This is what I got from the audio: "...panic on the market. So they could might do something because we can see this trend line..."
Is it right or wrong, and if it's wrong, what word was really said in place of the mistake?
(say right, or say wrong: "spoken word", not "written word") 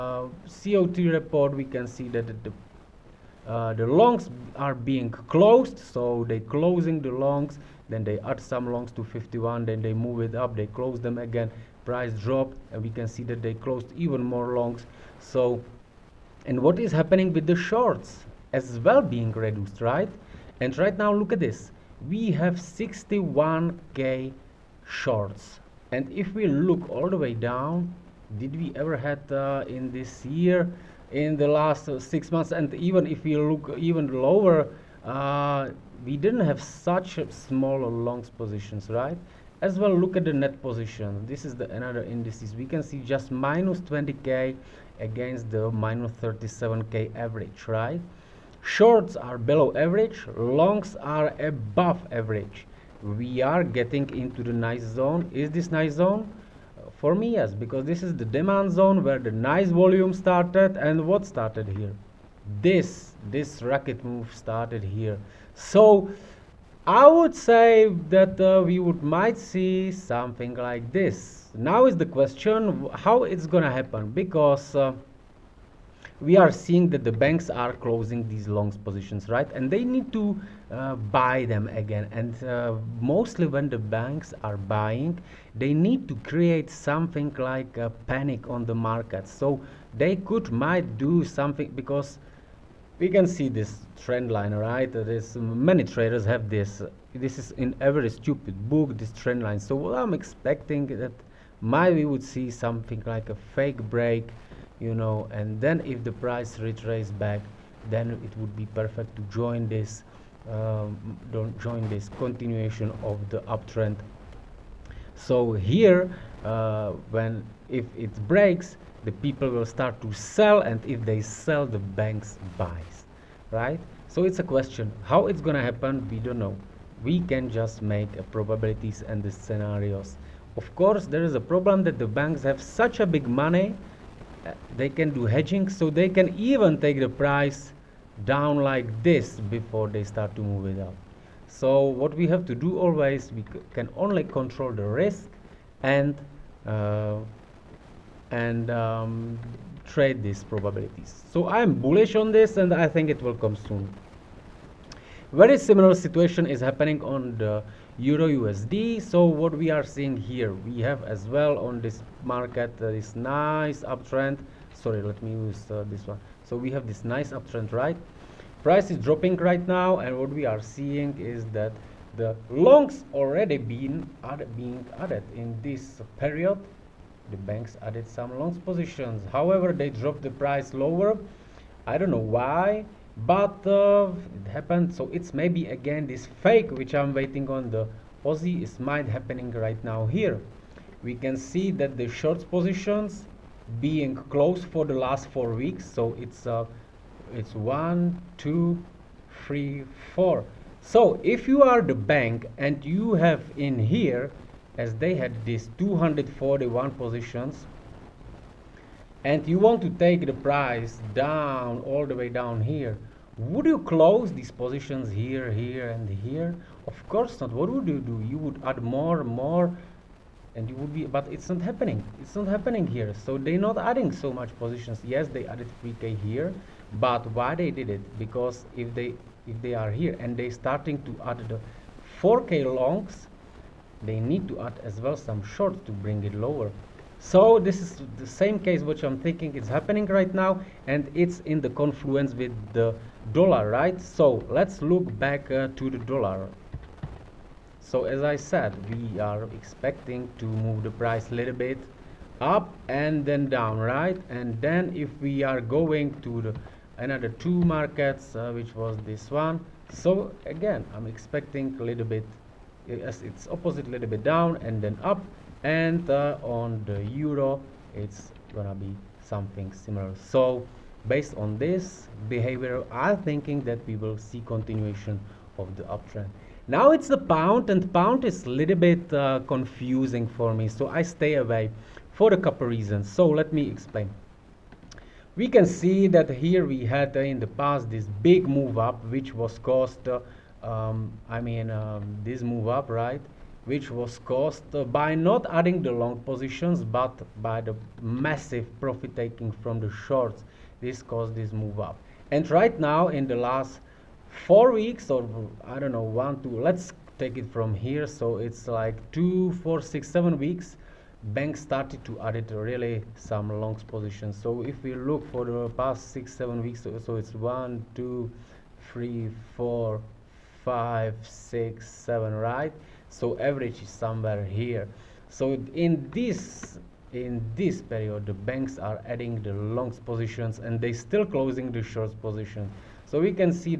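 right.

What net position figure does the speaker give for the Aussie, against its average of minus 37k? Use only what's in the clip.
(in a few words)
-20k.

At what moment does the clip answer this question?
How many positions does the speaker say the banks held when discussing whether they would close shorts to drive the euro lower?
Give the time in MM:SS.
03:25.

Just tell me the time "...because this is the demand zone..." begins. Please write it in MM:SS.
00:57.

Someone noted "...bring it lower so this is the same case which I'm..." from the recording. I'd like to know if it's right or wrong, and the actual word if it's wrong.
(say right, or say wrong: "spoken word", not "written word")
right.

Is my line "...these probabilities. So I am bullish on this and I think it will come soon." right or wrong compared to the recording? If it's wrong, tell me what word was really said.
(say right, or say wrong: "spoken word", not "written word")
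right.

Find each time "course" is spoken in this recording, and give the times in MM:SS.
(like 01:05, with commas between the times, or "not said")
02:10, 03:37.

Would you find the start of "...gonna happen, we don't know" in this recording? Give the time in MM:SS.
02:05.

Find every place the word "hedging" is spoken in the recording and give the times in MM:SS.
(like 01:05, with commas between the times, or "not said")
02:15.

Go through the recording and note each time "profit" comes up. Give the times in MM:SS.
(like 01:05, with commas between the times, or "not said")
04:58.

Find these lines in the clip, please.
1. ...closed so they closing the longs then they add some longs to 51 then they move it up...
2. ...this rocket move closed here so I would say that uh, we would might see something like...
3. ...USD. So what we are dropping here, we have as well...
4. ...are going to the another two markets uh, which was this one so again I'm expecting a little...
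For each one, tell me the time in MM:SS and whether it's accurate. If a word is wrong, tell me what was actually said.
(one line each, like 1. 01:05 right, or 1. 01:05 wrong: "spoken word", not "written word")
1. 00:05 right
2. 01:03 wrong: "started", not "closed"
3. 02:38 wrong: "seeing", not "dropping"
4. 04:15 right.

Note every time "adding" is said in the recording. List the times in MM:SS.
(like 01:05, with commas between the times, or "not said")
03:43, 04:55, 05:29.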